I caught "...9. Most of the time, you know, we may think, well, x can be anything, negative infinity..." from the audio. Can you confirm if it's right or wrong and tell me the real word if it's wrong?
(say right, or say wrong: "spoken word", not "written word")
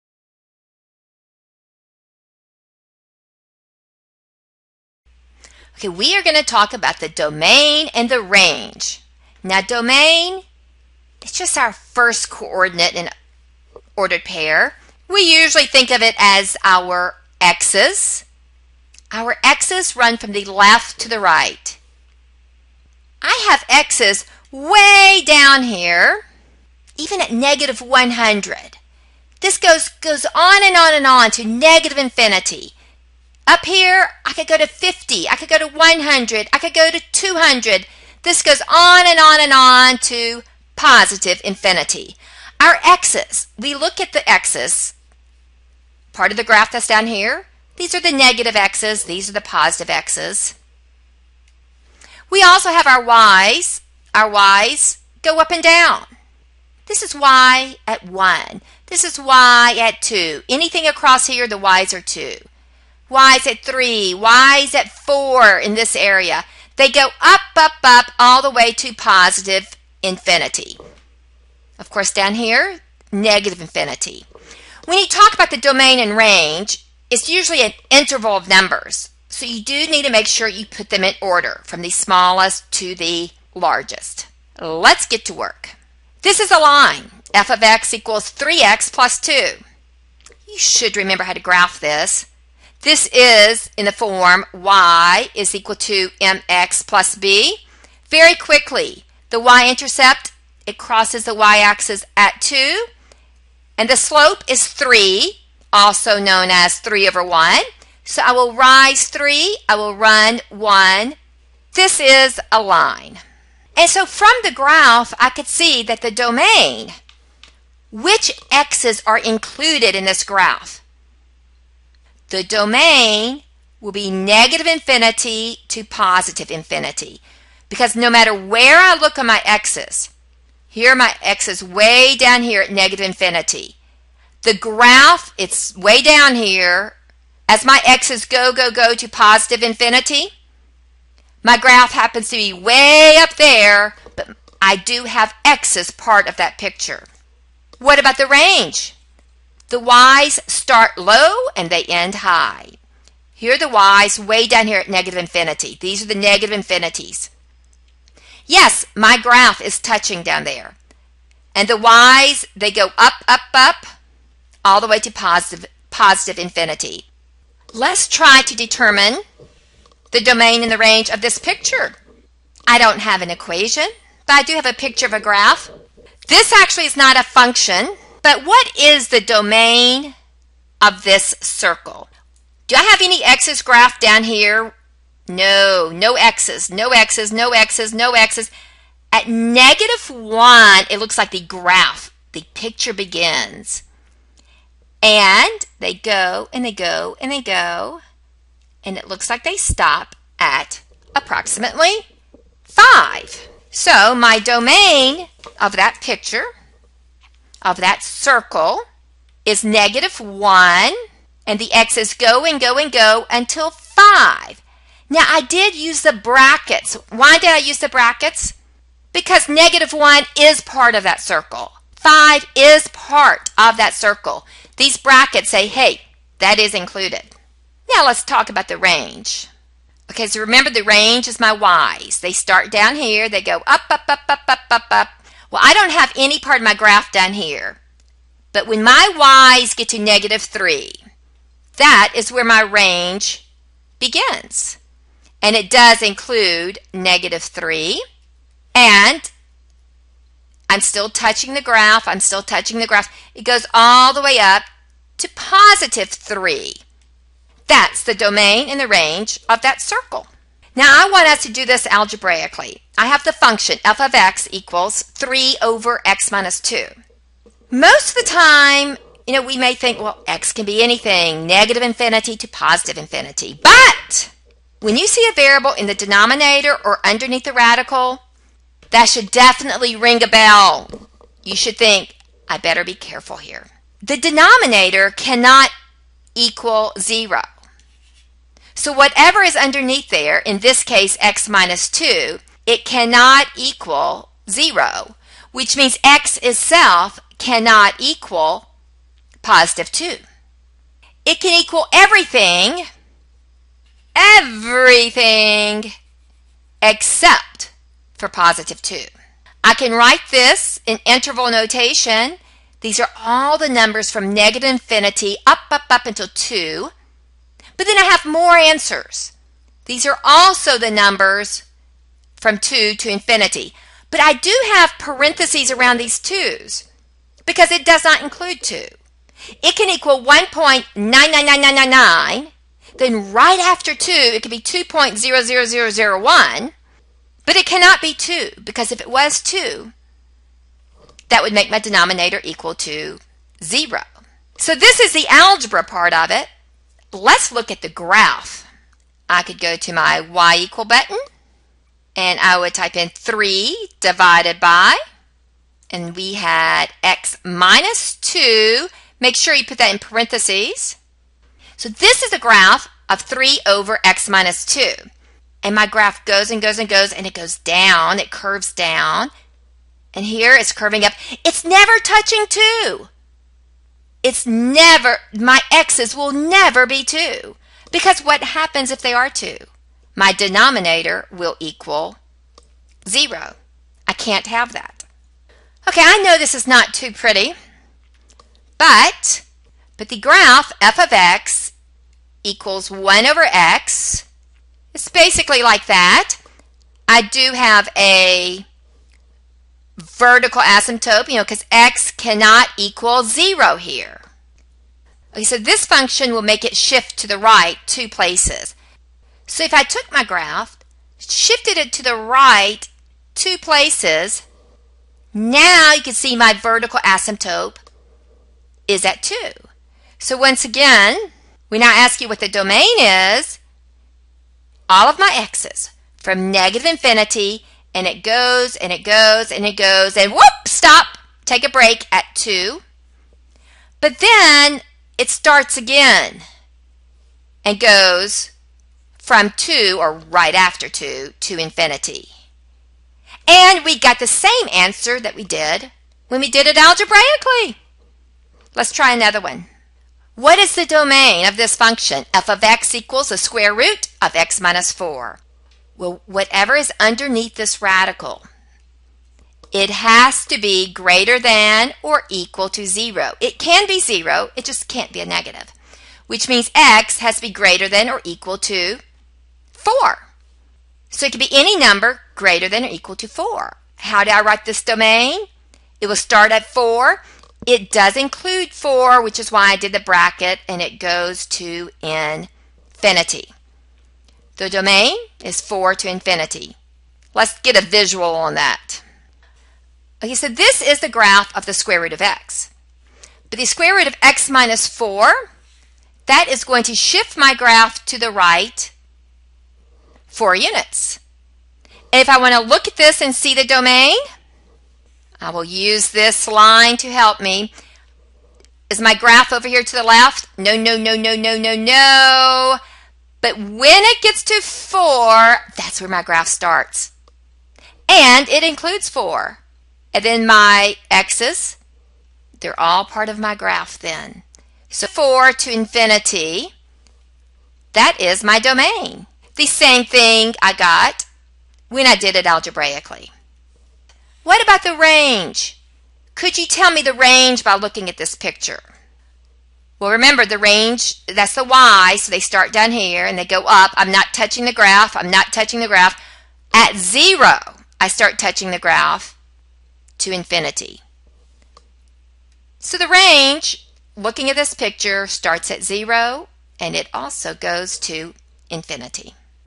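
wrong: "2", not "9".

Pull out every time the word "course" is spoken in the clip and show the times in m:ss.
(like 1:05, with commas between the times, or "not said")
1:11.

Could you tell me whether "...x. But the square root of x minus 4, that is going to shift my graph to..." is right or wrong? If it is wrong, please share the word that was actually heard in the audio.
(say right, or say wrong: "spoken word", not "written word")
right.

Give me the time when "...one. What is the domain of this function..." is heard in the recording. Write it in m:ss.
7:29.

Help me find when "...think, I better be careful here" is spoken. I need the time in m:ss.
4:41.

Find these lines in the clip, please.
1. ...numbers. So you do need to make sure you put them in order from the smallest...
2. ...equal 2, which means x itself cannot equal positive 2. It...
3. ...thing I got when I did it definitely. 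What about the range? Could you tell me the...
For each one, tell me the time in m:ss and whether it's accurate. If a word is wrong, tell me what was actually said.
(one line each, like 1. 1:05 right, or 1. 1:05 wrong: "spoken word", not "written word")
1. 1:18 right
2. 4:53 wrong: "0", not "2"
3. 8:50 wrong: "algebraically", not "definitely".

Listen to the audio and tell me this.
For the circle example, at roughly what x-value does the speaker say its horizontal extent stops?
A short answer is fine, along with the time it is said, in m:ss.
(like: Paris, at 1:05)
5, at 3:21.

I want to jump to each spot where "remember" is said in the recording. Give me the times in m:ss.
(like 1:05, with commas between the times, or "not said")
1:30, 3:50, 9:00.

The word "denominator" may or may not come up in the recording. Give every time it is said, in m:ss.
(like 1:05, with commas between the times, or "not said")
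4:35, 4:44, 5:41, 6:20.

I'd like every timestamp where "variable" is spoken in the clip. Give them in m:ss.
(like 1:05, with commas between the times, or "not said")
4:35.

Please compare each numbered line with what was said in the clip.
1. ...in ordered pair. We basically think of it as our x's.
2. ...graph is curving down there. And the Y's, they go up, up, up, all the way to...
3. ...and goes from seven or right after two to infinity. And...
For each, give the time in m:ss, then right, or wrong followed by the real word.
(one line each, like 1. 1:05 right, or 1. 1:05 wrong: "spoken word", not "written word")
1. 0:12 wrong: "usually", not "basically"
2. 2:39 wrong: "touching", not "curving"
3. 7:17 wrong: "two", not "seven".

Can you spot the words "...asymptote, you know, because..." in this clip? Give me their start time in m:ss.
6:40.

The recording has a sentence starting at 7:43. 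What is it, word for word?
It can be zero, it just can't be a negative, which means x has to be greater than or equal to 4.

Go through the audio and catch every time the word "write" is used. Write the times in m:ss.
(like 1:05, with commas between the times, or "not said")
5:09, 7:54.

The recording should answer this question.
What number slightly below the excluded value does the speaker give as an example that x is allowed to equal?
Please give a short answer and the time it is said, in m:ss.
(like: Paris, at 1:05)
1.99999, at 5:30.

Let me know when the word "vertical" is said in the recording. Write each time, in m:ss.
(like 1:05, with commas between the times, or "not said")
6:40, 6:56.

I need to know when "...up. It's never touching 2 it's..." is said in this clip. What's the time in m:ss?
6:11.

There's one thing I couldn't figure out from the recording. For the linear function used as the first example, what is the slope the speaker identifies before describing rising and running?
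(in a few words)
3.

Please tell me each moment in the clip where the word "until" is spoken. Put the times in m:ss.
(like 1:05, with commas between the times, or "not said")
3:33, 5:16.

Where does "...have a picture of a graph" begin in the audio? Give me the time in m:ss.
2:54.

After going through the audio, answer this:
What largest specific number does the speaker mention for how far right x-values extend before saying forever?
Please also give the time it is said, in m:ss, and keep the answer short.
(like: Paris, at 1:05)
200, at 0:37.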